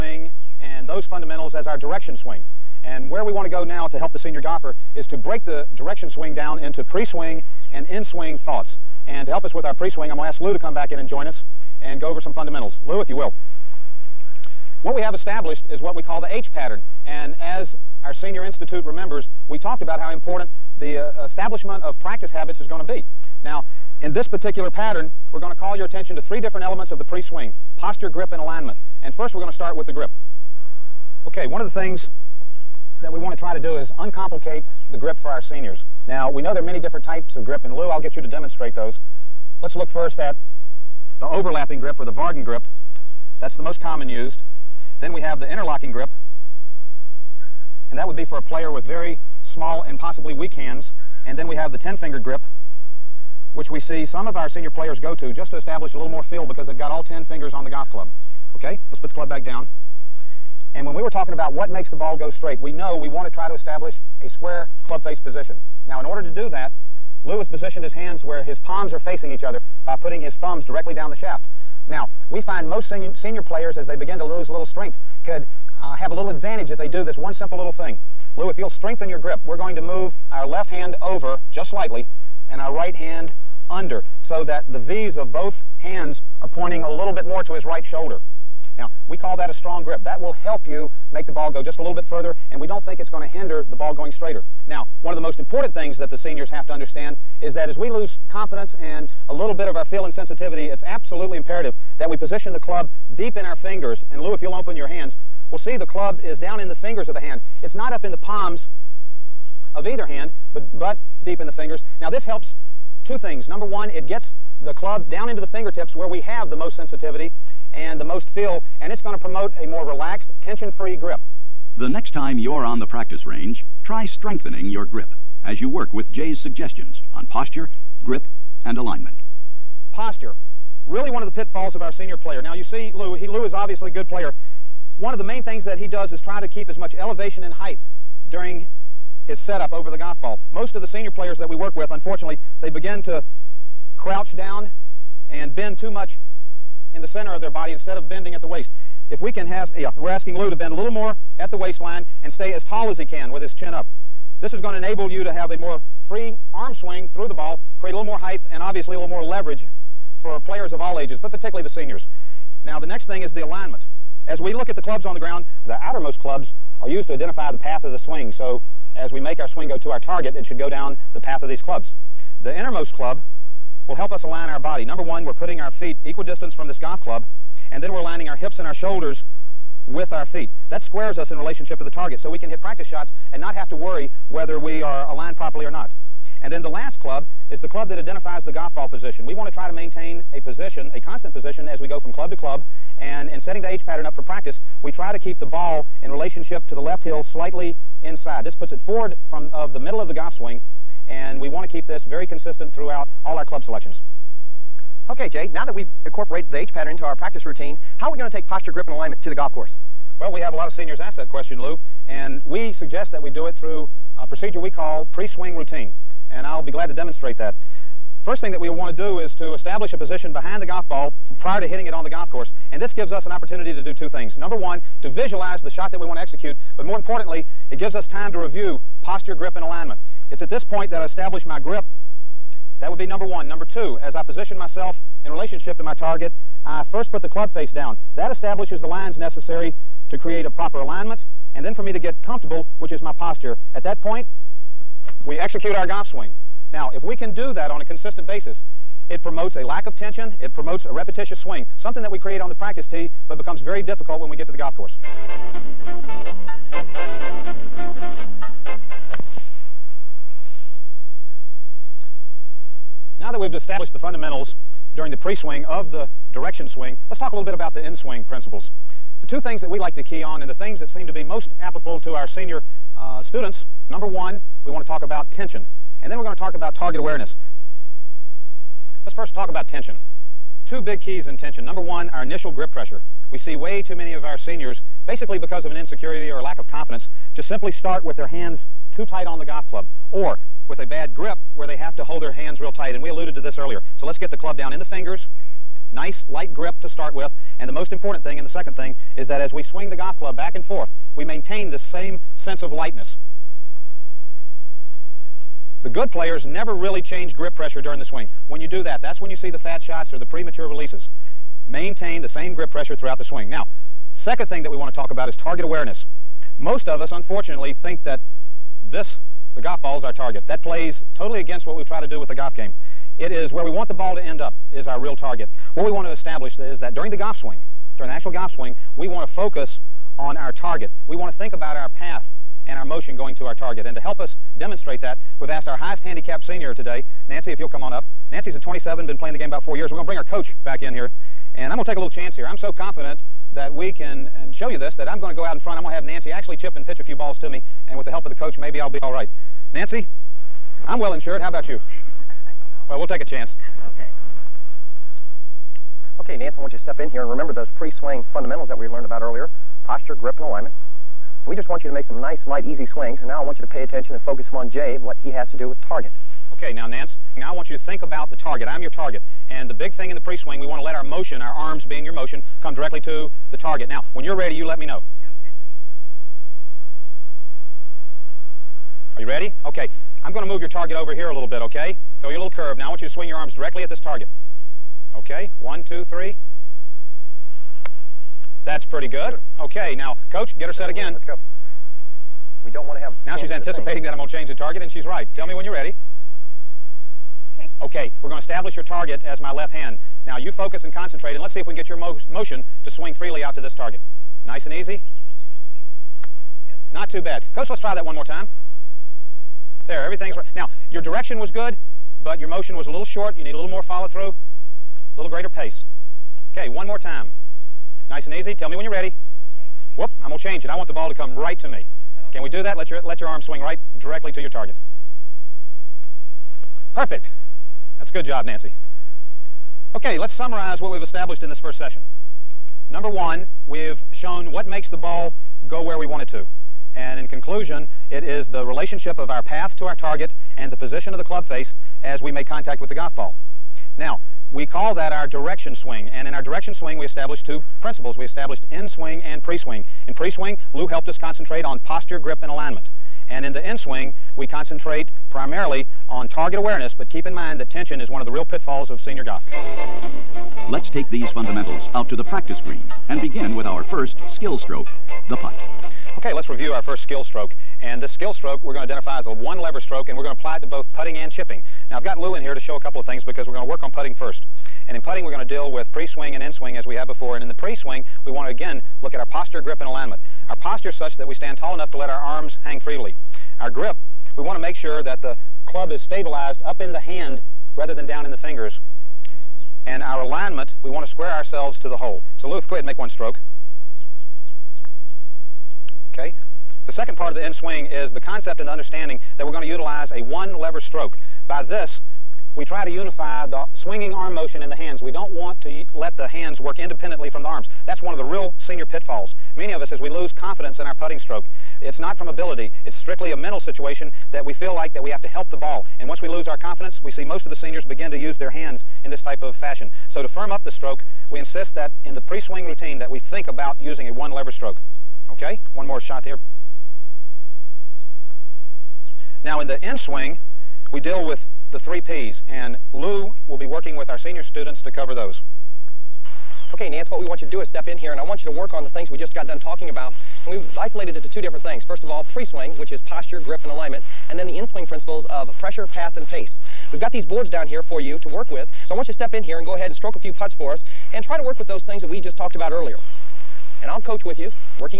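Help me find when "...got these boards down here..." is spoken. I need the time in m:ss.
9:06.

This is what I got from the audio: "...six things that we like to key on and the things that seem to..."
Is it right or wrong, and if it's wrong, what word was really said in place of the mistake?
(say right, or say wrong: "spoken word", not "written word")
wrong: "two", not "six".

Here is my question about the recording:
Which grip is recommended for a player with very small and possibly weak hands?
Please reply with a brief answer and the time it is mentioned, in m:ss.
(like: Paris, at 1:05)
Interlocking grip, at 0:45.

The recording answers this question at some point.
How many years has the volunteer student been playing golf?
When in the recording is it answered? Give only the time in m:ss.
5:39.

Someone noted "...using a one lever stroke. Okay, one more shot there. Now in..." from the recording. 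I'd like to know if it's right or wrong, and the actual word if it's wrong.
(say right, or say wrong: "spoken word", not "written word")
right.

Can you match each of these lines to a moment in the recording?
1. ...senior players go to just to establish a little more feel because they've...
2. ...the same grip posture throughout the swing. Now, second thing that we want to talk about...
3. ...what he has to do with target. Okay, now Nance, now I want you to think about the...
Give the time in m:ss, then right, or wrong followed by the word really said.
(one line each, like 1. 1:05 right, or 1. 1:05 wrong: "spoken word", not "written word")
1. 0:54 right
2. 5:12 wrong: "pressure", not "posture"
3. 6:04 right.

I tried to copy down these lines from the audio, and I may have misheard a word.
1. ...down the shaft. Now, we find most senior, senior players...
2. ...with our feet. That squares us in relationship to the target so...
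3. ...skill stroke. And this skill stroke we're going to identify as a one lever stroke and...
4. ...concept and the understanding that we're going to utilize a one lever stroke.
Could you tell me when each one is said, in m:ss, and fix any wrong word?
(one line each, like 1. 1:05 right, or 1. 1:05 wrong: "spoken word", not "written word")
1. 1:10 right
2. 2:59 right
3. 7:47 right
4. 8:18 right.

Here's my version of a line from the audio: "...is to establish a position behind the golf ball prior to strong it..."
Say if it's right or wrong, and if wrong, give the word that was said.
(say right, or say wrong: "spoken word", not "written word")
wrong: "hitting", not "strong".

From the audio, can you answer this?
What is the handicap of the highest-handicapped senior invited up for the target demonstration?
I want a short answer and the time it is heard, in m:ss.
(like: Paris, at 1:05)
27, at 5:38.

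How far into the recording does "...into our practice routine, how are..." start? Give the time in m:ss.
3:26.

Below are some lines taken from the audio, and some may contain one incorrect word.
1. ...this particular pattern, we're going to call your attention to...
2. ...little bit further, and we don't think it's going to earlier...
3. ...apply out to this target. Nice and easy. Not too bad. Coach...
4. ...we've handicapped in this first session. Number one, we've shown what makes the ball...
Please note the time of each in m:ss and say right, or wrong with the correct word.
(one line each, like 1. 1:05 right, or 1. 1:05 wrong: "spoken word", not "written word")
1. 0:24 right
2. 1:31 wrong: "hinder", not "earlier"
3. 6:43 wrong: "freely", not "apply"
4. 7:10 wrong: "established", not "handicapped".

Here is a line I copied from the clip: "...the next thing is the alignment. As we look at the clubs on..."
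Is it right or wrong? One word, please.
right.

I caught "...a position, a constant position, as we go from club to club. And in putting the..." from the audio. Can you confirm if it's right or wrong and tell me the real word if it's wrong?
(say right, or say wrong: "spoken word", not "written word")
wrong: "setting", not "putting".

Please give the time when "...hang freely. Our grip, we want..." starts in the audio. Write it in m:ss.
8:02.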